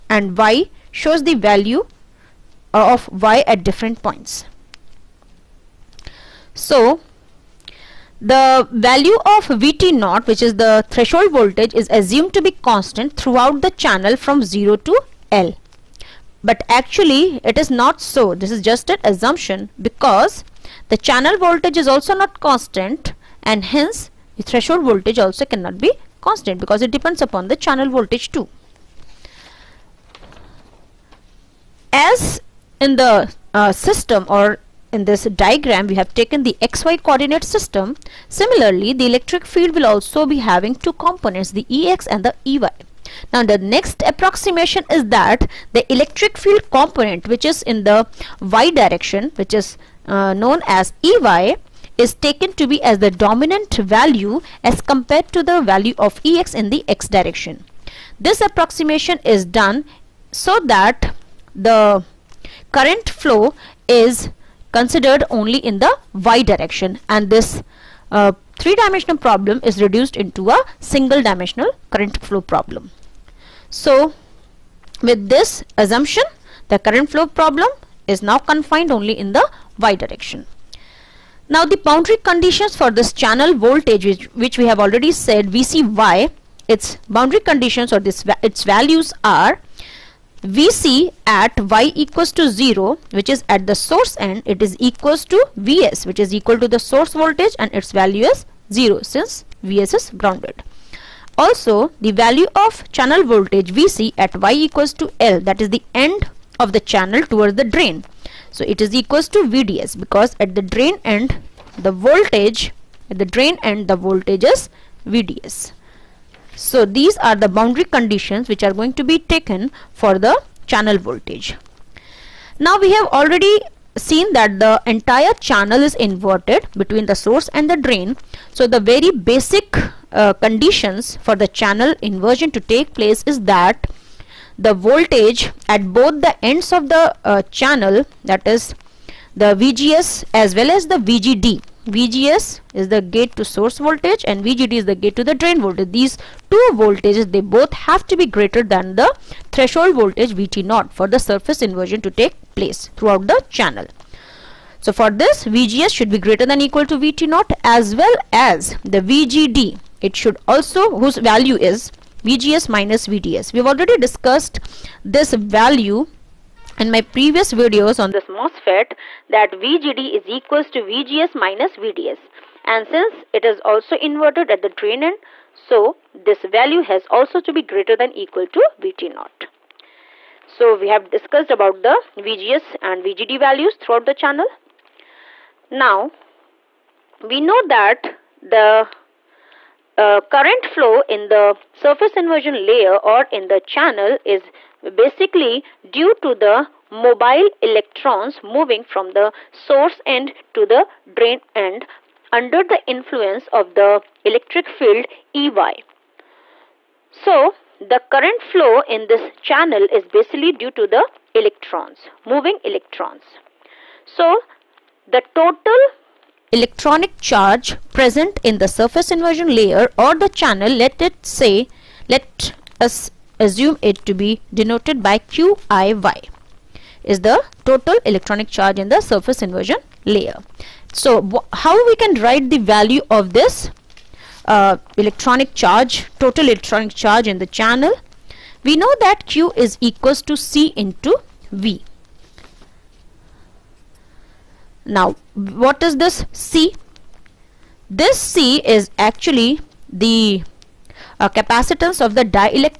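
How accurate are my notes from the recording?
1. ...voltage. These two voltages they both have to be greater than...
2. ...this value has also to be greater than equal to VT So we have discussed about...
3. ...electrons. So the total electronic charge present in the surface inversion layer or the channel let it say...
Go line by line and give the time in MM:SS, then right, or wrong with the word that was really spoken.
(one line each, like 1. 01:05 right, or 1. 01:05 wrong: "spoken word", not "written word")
1. 02:25 right
2. 02:56 right
3. 03:32 right.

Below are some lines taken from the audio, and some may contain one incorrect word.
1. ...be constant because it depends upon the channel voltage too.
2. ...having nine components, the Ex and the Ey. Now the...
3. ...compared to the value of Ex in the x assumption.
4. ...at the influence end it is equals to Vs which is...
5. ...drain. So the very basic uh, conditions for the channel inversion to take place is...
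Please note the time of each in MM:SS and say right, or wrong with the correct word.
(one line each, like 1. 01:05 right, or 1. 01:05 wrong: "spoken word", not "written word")
1. 00:25 right
2. 00:40 wrong: "two", not "nine"
3. 00:54 wrong: "direction", not "assumption"
4. 01:33 wrong: "source", not "influence"
5. 02:07 right.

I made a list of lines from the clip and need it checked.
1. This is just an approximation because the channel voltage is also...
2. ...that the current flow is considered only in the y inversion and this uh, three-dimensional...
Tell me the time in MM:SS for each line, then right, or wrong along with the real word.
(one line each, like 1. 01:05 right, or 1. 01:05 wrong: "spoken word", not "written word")
1. 00:18 wrong: "assumption", not "approximation"
2. 01:00 wrong: "direction", not "inversion".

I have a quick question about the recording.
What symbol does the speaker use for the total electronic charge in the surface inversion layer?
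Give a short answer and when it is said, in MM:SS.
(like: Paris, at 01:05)
QIY, at 03:45.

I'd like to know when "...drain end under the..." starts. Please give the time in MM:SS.
03:21.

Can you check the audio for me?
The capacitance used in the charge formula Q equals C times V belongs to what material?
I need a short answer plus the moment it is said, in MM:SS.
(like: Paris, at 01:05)
the dielectric, at 04:12.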